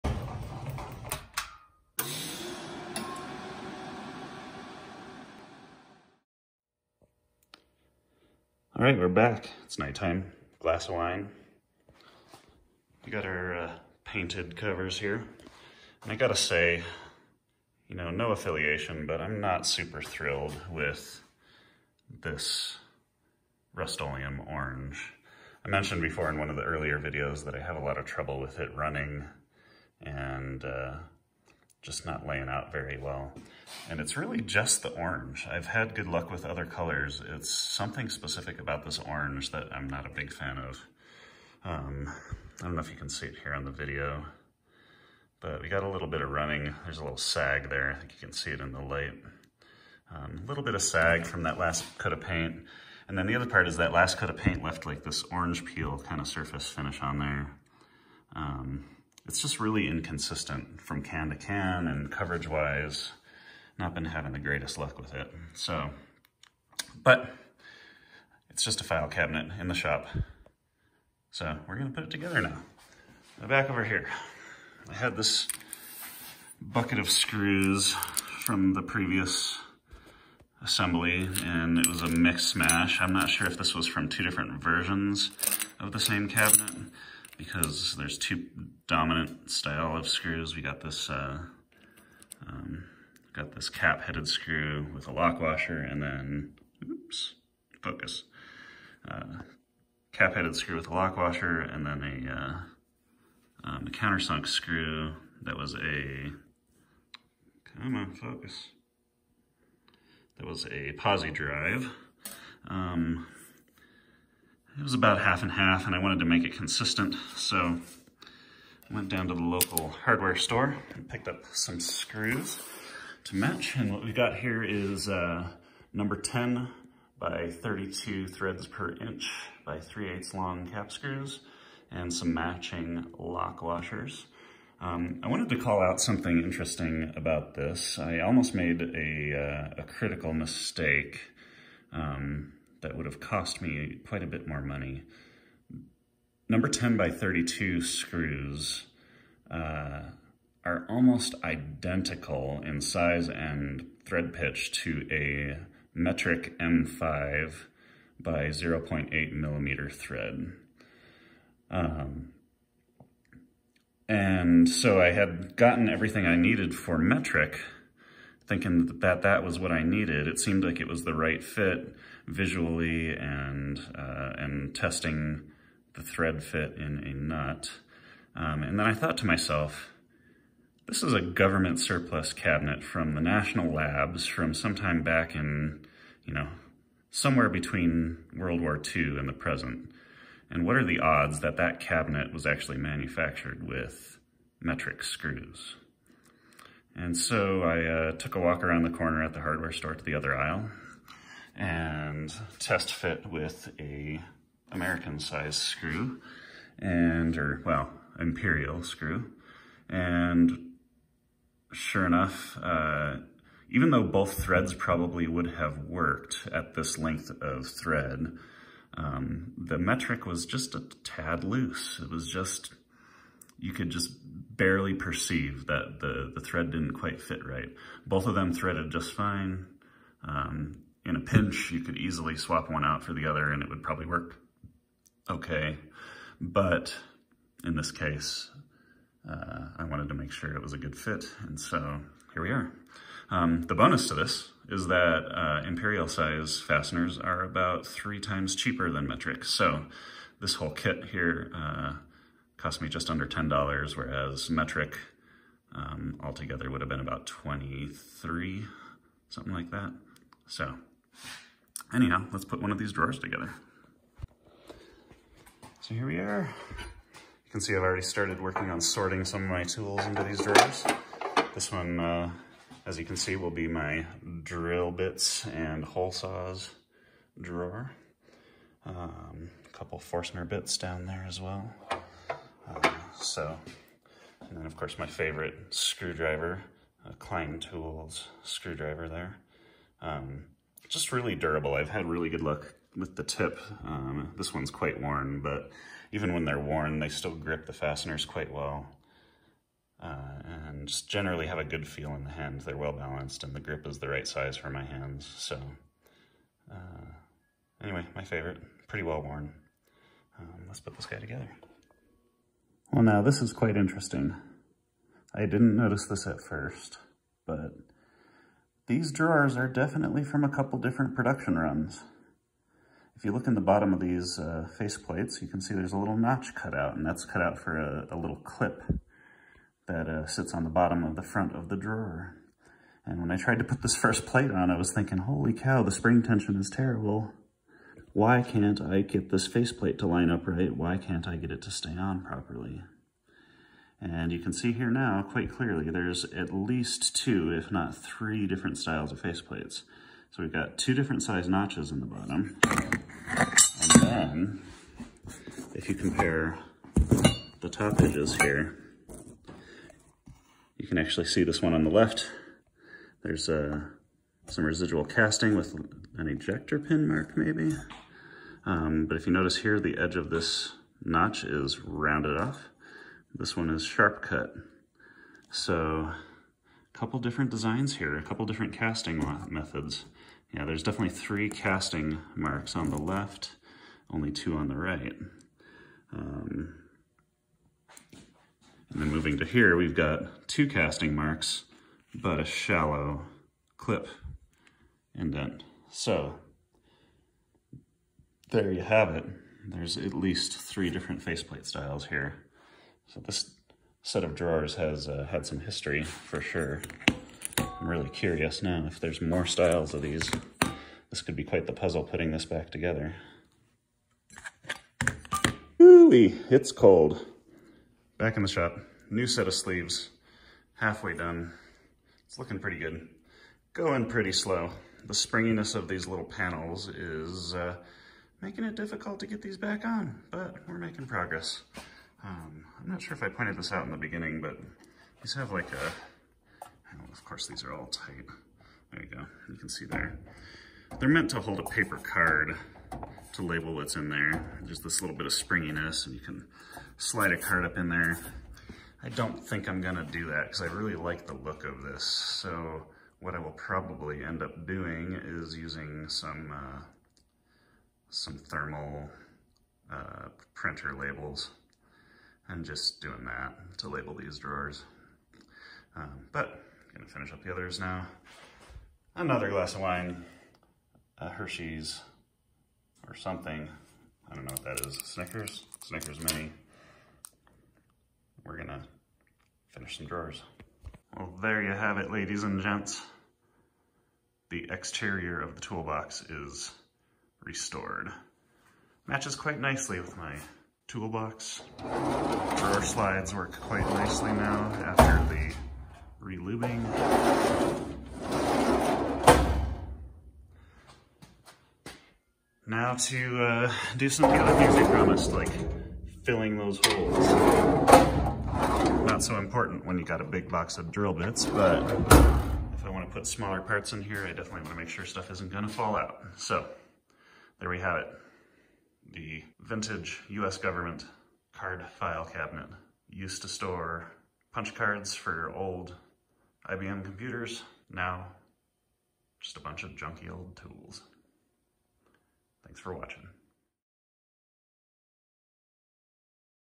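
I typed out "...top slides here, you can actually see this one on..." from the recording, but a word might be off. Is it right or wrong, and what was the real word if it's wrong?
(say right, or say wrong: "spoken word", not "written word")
wrong: "edges", not "slides".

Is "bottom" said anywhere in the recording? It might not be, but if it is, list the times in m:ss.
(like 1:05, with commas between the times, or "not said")
5:23, 5:30, 5:52.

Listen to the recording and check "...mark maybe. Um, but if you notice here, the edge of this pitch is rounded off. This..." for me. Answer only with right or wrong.
wrong.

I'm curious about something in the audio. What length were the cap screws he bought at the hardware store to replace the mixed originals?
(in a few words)
3/8 inch.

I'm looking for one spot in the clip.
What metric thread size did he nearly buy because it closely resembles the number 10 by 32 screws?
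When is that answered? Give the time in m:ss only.
2:36.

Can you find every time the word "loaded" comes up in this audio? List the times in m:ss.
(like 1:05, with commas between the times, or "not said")
not said.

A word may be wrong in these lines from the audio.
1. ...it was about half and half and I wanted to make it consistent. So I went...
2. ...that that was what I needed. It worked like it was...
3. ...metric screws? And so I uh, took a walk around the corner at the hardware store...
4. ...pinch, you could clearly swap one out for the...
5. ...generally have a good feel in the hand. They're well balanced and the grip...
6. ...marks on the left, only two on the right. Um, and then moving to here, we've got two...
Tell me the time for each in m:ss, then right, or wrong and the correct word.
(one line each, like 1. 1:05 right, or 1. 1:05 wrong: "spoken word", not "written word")
1. 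1:54 right
2. 2:48 wrong: "seemed", not "worked"
3. 3:14 right
4. 3:51 wrong: "easily", not "clearly"
5. 5:01 right
6. 6:22 right.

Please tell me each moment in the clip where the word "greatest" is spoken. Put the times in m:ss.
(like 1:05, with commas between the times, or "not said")
1:04.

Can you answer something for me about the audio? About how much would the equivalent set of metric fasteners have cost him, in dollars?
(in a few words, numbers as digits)
$23.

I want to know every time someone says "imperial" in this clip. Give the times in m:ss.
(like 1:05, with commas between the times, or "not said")
3:28, 4:05.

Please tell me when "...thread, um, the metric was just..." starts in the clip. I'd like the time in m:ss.
3:37.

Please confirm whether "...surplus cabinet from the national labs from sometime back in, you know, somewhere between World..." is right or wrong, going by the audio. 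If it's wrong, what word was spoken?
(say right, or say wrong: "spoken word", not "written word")
right.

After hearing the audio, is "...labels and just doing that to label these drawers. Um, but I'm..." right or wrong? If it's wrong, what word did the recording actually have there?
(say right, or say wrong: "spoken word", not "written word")
right.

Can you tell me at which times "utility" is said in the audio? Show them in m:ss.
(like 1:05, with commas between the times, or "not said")
not said.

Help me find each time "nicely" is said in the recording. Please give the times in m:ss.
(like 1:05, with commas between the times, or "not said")
8:09, 8:13.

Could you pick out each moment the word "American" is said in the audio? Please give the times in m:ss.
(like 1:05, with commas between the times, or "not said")
3:24.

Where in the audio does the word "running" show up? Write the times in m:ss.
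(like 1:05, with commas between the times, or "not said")
0:28, 0:46.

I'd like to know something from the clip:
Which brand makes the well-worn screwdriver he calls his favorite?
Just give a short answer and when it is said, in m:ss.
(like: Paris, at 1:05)
Klein Tools, at 4:47.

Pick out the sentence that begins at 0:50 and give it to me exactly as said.
Um, a little bit of sag from that last coat of paint.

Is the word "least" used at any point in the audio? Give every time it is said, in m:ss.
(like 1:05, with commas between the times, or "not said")
5:46, 6:40.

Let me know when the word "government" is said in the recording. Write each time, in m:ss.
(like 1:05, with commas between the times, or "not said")
3:01, 8:40.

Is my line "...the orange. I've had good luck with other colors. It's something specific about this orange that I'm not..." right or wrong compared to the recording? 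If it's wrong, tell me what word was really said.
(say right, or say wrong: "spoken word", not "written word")
right.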